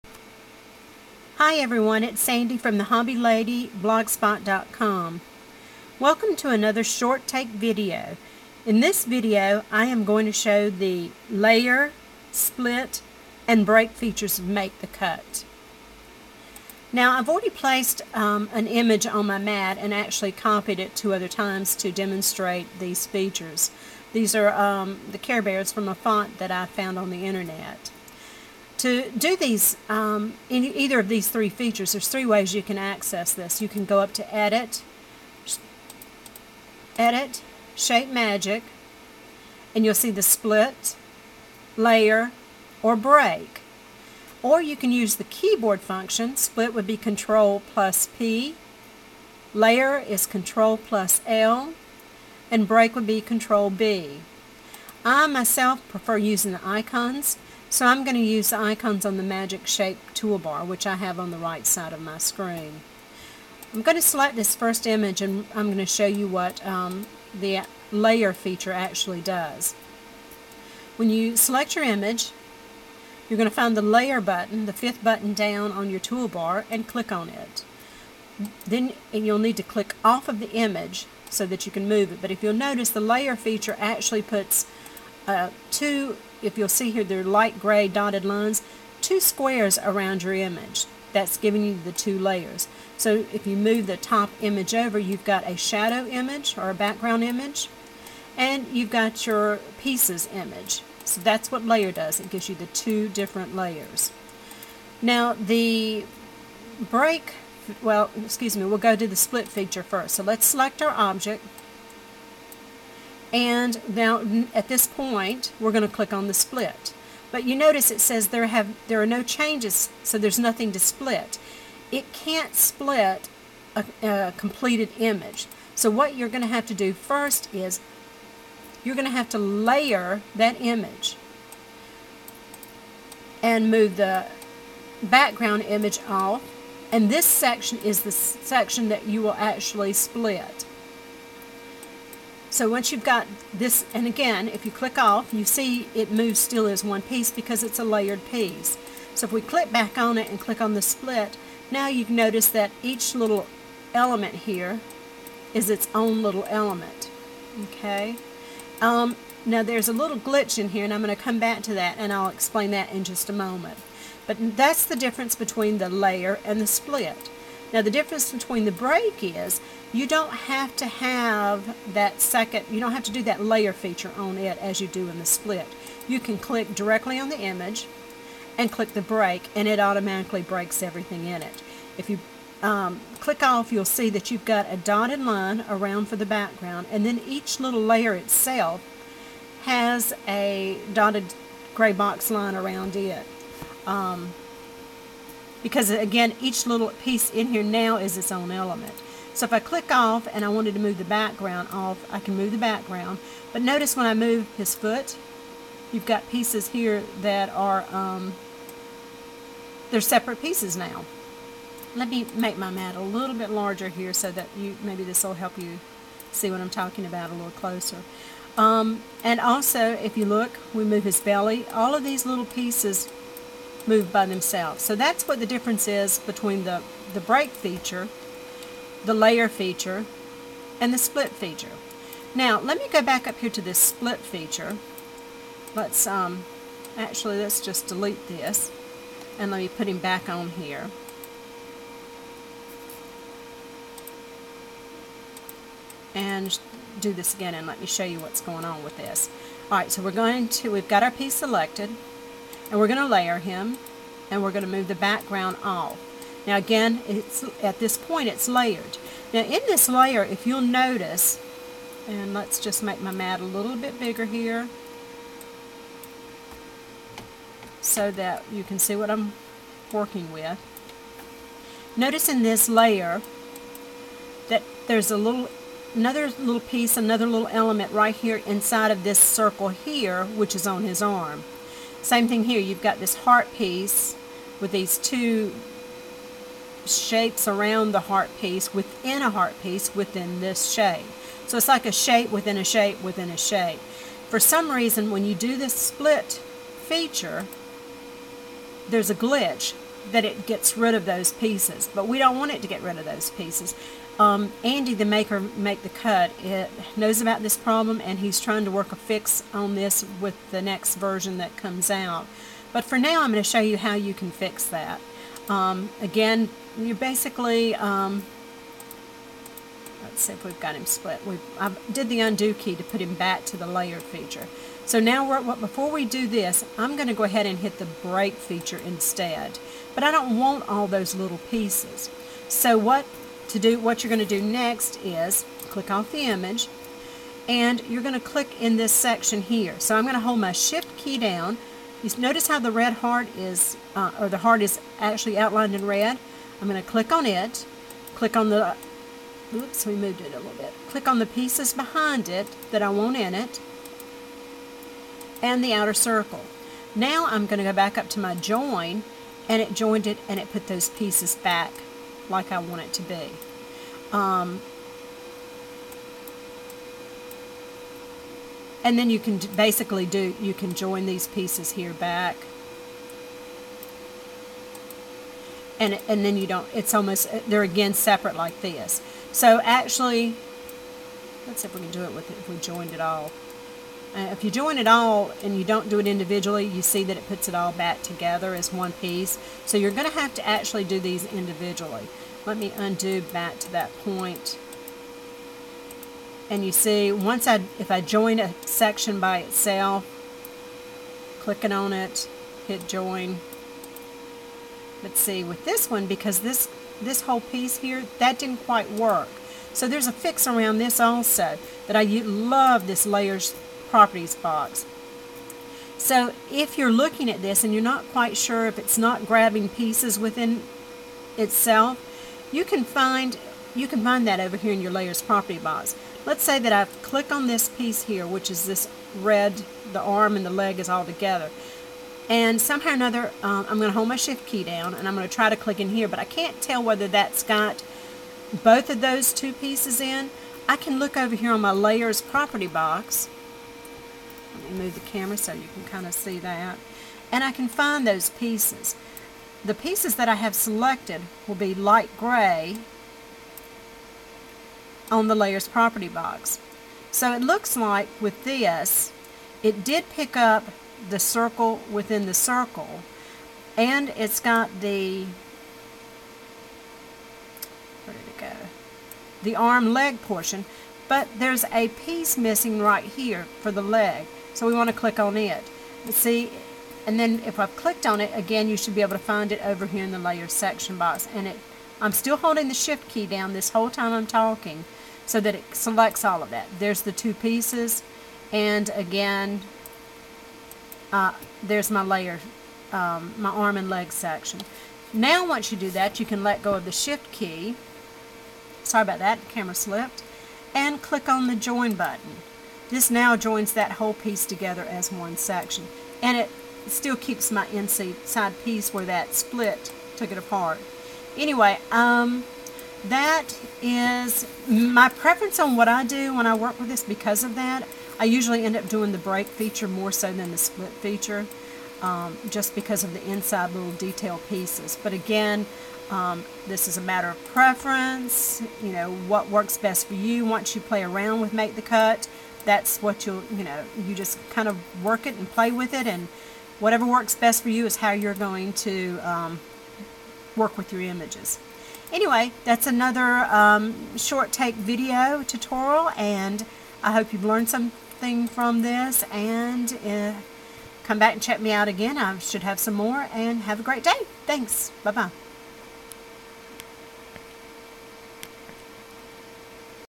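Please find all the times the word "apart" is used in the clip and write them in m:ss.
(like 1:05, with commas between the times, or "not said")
8:30.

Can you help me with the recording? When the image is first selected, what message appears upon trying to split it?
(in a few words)
no changes.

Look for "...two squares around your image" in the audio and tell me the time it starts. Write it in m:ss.
1:29.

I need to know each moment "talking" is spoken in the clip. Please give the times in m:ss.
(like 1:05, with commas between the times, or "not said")
3:36, 8:04.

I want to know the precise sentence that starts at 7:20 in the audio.
I can look over here on my layers property box.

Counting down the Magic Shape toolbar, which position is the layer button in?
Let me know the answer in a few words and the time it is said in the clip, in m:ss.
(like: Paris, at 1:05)
fifth, at 1:14.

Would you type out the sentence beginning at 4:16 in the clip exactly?
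Now again, it's at this point it's layered.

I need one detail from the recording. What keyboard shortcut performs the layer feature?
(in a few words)
Control plus L.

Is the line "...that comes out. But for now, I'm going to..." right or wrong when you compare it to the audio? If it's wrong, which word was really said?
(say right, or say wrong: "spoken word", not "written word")
right.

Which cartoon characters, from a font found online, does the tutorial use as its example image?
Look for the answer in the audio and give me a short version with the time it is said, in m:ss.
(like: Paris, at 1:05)
Care Bears, at 0:25.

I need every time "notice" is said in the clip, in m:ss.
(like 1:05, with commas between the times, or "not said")
1:22, 1:57, 2:32, 3:23, 4:20, 4:31, 5:42.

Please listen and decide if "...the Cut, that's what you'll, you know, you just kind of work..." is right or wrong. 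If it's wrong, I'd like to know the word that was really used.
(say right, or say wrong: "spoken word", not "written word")
right.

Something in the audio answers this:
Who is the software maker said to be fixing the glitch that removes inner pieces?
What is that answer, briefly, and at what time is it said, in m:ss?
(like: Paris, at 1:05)
Andy, at 5:04.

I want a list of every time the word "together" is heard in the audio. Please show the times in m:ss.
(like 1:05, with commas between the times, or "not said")
6:28, 7:11, 8:24.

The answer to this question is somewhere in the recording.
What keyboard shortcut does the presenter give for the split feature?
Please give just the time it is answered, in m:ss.
0:46.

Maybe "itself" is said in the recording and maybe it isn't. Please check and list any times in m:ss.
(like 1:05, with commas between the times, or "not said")
3:08, 6:39, 7:01.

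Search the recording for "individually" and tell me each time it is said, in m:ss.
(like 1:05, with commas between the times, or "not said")
6:26, 6:31.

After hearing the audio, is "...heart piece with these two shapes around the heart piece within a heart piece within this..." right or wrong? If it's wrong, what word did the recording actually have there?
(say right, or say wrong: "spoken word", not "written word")
right.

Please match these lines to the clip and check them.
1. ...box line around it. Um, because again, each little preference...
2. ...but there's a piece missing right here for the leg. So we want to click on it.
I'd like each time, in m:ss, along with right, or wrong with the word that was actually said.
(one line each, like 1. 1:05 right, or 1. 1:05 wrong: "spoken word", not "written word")
1. 3:11 wrong: "piece", not "preference"
2. 7:51 right.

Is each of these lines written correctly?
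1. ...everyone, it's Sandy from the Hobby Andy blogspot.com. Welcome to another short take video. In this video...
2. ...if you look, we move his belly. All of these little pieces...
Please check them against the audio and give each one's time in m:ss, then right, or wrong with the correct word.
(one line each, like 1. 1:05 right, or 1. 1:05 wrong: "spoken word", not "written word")
1. 0:01 wrong: "Lady", not "Andy"
2. 3:39 right.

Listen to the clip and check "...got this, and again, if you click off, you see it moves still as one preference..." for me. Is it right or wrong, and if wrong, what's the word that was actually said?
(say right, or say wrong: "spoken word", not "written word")
wrong: "piece", not "preference".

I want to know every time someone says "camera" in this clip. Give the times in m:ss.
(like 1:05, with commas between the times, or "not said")
7:25, 8:19.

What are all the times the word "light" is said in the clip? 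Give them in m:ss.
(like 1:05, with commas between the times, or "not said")
1:27, 7:31.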